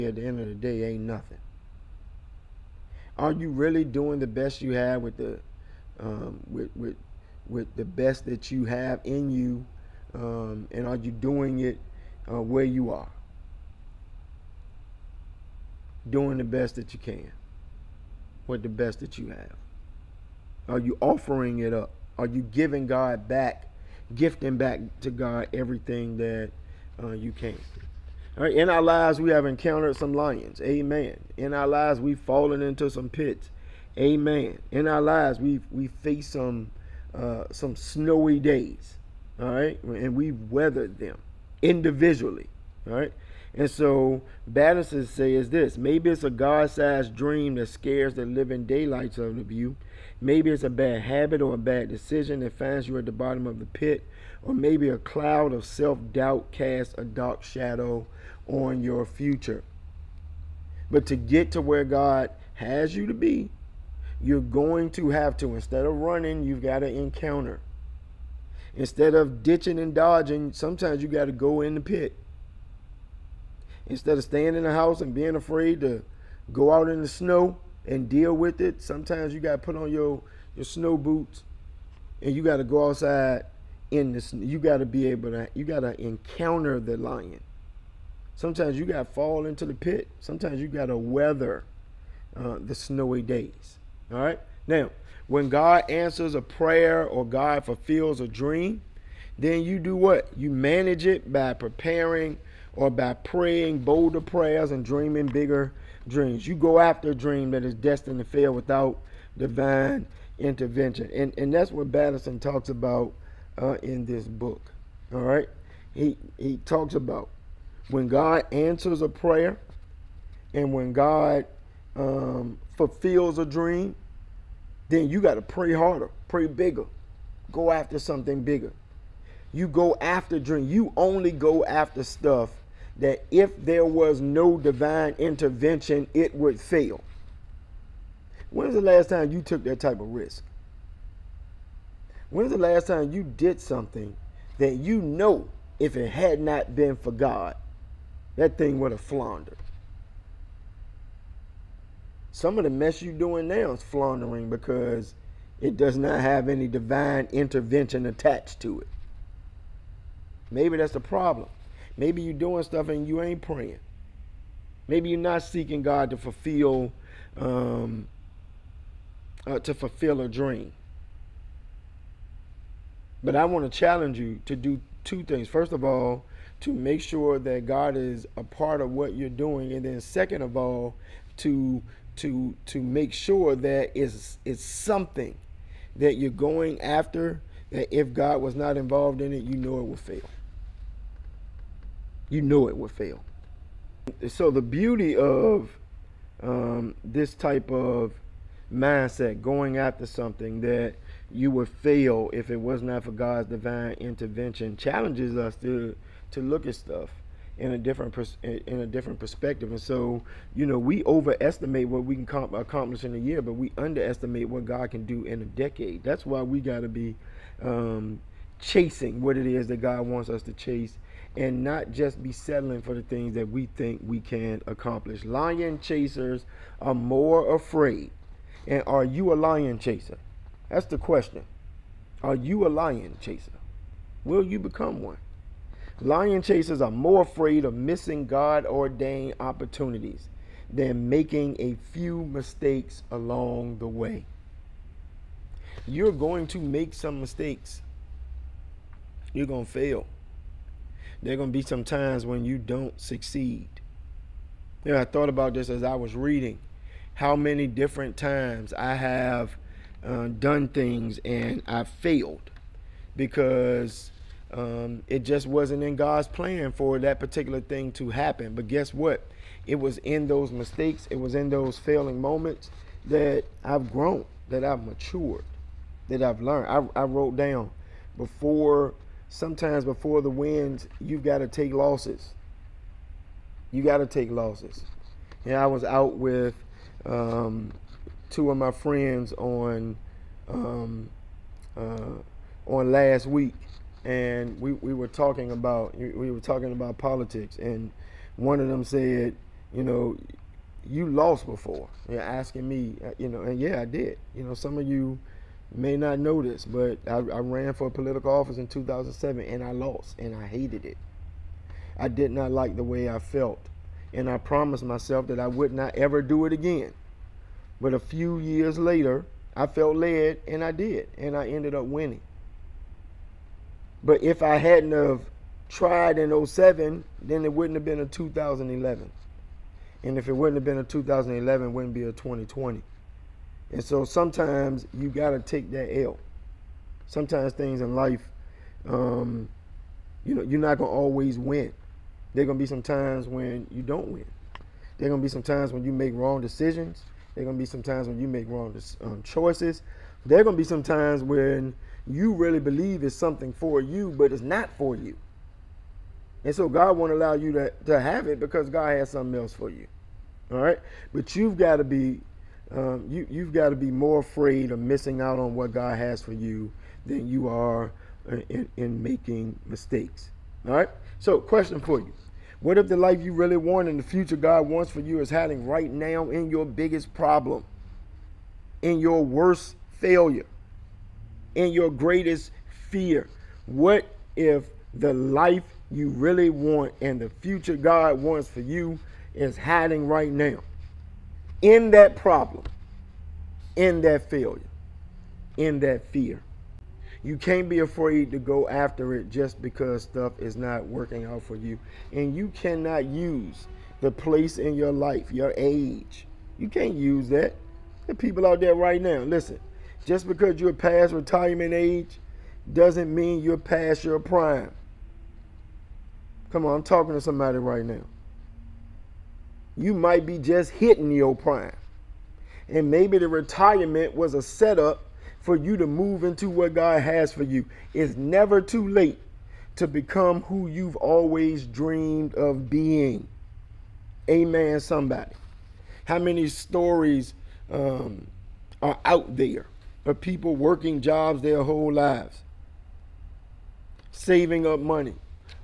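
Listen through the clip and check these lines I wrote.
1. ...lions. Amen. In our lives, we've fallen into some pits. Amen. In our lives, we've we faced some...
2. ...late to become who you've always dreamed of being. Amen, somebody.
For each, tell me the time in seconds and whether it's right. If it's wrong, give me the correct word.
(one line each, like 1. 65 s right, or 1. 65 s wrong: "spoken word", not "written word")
1. 30 s right
2. 428 s right.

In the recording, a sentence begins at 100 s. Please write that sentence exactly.
You manage it by preparing or by praying bolder prayers and dreaming bigger dreams.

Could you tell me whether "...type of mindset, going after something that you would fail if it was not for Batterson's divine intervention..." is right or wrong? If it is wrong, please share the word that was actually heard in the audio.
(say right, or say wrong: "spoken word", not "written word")
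wrong: "God", not "Batterson".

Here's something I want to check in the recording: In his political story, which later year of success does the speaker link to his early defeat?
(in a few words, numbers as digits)
2020.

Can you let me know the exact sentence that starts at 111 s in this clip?
And, and that's what Batterson talks about uh, in this book.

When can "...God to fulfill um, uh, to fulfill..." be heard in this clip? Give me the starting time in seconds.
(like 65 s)
165 s.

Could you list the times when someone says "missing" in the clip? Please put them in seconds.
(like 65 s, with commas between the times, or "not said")
237 s, 364 s.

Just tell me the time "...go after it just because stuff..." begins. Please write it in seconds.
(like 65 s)
398 s.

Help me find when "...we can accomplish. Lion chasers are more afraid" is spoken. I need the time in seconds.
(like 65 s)
224 s.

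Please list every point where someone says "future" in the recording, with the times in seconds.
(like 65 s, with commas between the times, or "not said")
59 s, 374 s, 387 s.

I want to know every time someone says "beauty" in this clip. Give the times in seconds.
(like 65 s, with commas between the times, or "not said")
194 s.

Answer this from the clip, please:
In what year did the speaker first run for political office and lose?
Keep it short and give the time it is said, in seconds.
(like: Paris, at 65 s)
2007, at 308 s.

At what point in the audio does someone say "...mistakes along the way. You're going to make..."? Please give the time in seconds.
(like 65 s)
242 s.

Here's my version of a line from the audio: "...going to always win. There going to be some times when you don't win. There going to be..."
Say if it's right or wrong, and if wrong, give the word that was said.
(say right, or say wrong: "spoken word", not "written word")
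right.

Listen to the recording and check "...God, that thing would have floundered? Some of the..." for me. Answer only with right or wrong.
right.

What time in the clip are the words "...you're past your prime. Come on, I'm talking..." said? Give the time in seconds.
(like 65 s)
413 s.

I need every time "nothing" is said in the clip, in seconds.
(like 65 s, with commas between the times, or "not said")
1 s.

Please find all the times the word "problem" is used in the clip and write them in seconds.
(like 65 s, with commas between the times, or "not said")
160 s, 377 s, 392 s.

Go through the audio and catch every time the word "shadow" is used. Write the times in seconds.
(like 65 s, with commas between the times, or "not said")
57 s.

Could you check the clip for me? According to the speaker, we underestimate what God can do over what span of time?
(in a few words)
a decade.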